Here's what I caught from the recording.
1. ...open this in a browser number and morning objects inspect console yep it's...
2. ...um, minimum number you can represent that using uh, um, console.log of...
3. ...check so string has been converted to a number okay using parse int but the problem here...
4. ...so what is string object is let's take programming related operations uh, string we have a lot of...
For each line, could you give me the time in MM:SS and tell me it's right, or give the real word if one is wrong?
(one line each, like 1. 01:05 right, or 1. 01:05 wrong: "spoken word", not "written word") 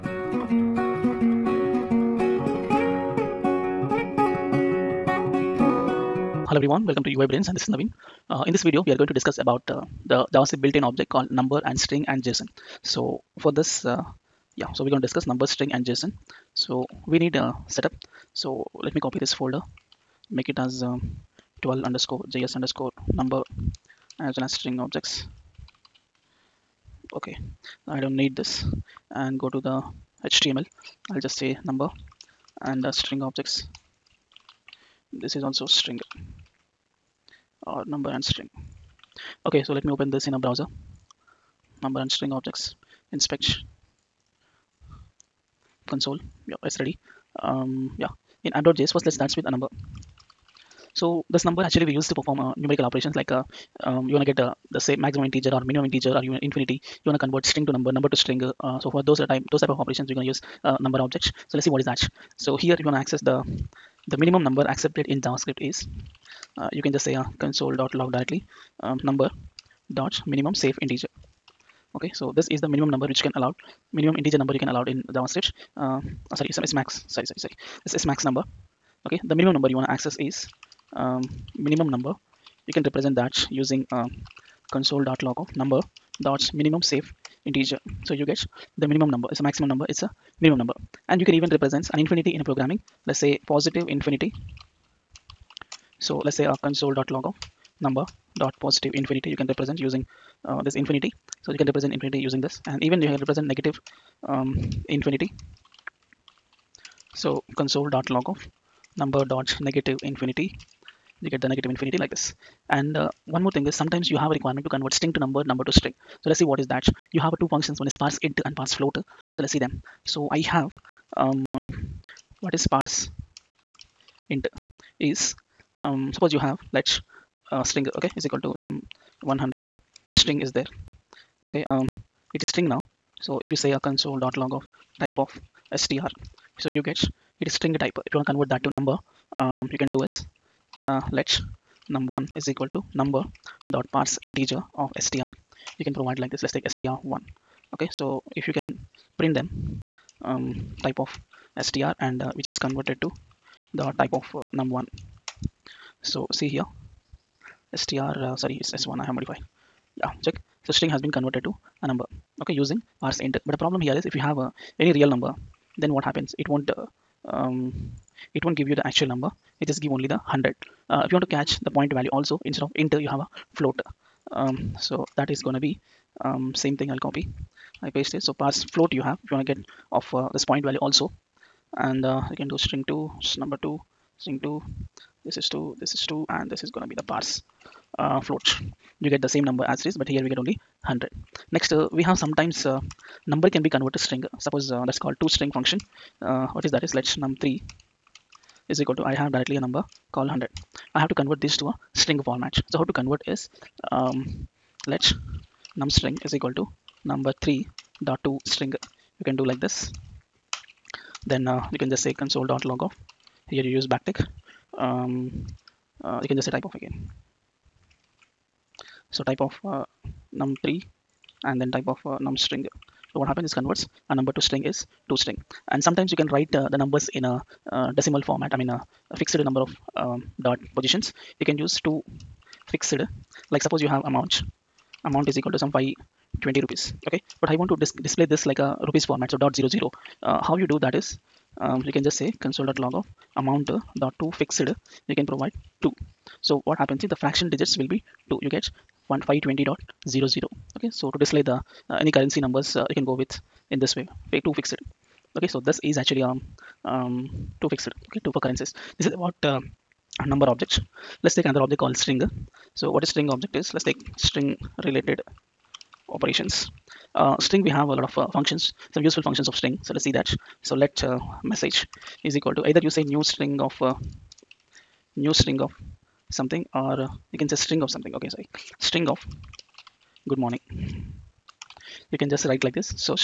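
1. 00:39 wrong: "string", not "morning"
2. 01:21 right
3. 02:40 right
4. 04:22 wrong: "string", not "programming".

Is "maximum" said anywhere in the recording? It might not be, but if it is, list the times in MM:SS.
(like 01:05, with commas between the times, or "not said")
00:55, 01:29.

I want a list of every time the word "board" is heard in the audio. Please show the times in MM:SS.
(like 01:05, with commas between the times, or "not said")
not said.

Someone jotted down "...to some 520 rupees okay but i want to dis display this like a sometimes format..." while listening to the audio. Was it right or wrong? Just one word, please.
wrong.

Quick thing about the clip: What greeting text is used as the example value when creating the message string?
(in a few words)
Good morning.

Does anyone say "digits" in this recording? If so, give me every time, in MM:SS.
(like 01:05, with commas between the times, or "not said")
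04:07.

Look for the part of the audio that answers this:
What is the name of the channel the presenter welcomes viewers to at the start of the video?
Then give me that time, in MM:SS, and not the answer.
00:07.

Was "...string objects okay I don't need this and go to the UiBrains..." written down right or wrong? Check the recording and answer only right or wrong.
wrong.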